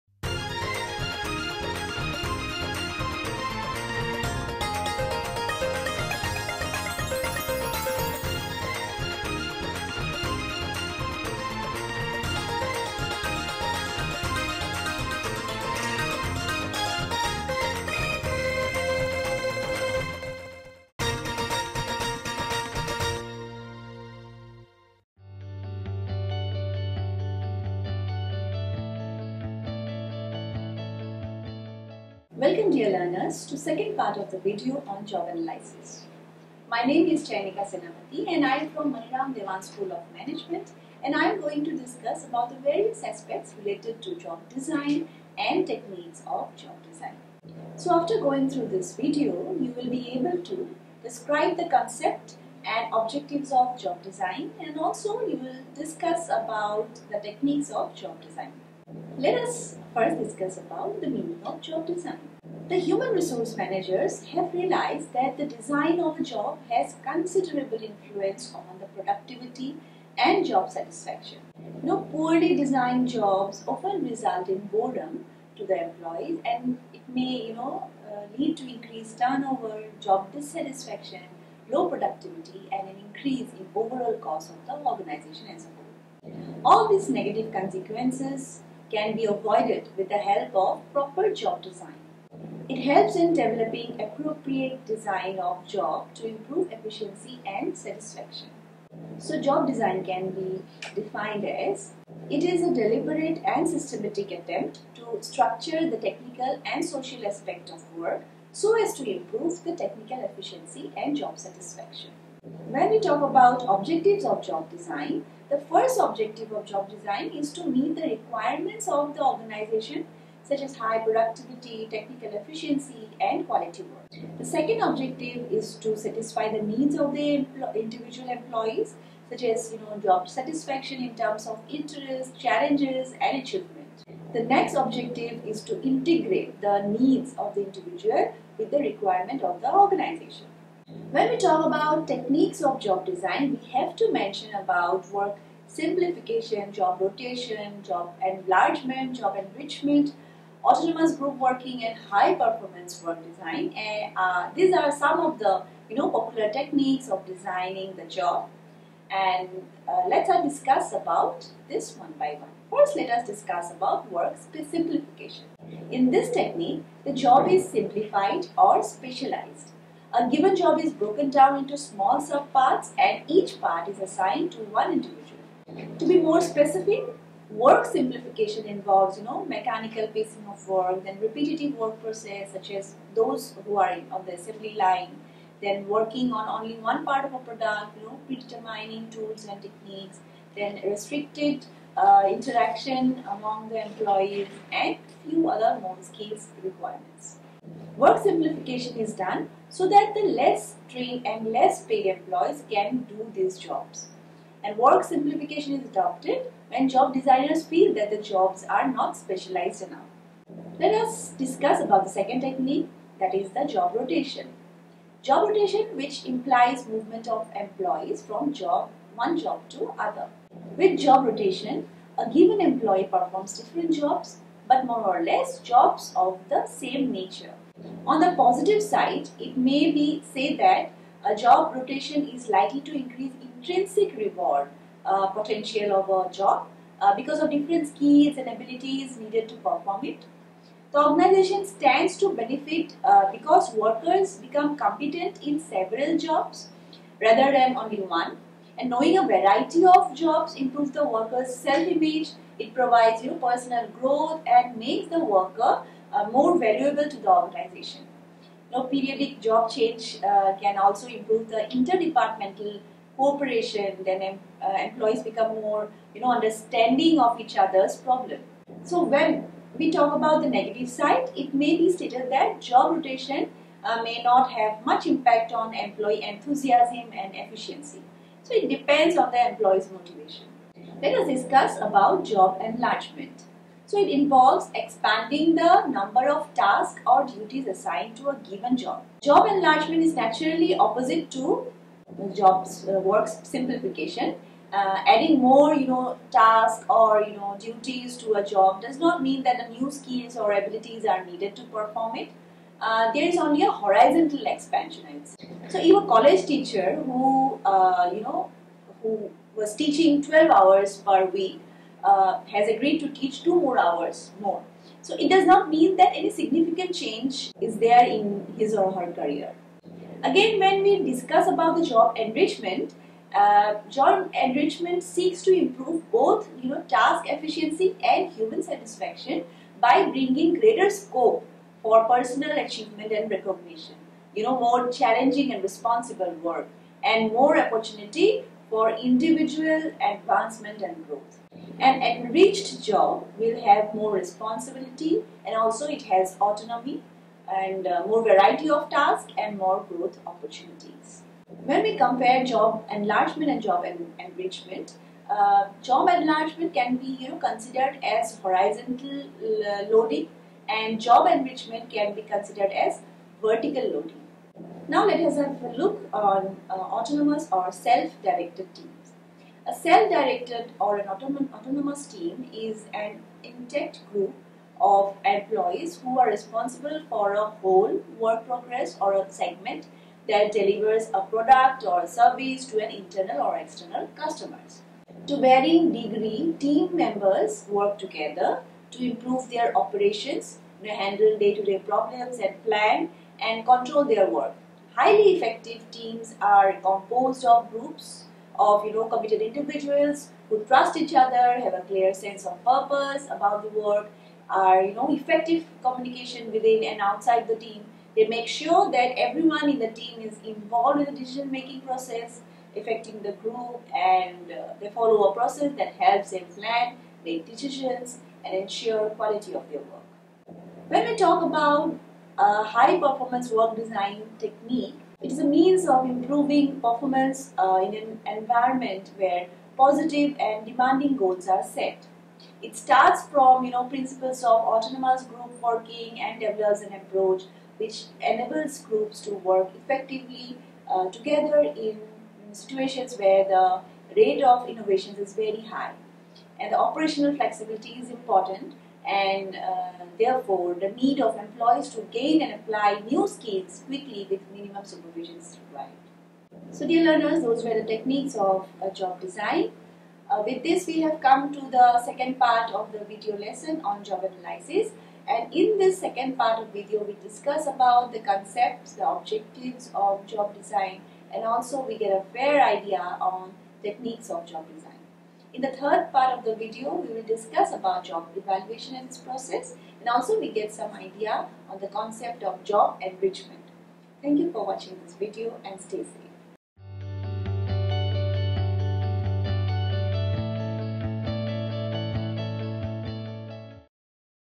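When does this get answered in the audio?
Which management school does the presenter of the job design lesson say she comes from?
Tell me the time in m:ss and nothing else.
0:38.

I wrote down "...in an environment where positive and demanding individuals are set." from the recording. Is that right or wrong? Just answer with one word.
wrong.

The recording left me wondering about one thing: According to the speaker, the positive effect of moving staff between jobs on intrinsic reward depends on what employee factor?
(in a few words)
Motivation.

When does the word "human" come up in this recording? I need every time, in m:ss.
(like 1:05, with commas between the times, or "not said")
1:02, 5:28.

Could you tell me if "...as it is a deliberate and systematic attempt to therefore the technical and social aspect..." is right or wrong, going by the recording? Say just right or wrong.
wrong.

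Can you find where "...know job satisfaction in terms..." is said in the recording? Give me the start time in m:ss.
2:09.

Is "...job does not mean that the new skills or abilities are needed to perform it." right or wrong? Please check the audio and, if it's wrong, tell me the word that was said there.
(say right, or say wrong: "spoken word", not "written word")
right.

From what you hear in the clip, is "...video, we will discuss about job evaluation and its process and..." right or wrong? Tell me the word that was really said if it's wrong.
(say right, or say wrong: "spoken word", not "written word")
right.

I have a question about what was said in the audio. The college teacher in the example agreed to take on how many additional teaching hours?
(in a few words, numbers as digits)
2.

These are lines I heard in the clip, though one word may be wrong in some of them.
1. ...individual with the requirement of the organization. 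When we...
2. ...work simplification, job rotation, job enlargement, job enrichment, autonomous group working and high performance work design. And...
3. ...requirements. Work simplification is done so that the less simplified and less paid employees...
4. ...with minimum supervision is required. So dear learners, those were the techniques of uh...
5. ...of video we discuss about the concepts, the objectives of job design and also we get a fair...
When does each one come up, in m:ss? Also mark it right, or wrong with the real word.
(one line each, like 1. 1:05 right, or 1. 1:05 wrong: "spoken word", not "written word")
1. 2:17 right
2. 2:25 right
3. 3:16 wrong: "trained", not "simplified"
4. 7:34 right
5. 7:46 right.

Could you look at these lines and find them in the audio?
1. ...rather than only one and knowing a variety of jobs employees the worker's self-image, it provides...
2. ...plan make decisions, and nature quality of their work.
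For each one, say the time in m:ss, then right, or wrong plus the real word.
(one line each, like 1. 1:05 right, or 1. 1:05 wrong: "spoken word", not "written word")
1. 4:07 wrong: "improves", not "employees"
2. 6:56 wrong: "ensure", not "nature".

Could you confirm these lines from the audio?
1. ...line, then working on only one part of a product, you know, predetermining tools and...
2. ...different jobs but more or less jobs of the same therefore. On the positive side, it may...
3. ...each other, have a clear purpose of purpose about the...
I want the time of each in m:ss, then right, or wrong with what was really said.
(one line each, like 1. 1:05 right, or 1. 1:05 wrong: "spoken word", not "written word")
1. 3:04 right
2. 3:43 wrong: "nature", not "therefore"
3. 6:41 wrong: "sense", not "purpose".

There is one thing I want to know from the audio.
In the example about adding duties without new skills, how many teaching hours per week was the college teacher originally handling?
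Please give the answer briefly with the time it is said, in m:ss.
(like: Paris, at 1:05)
12, at 5:10.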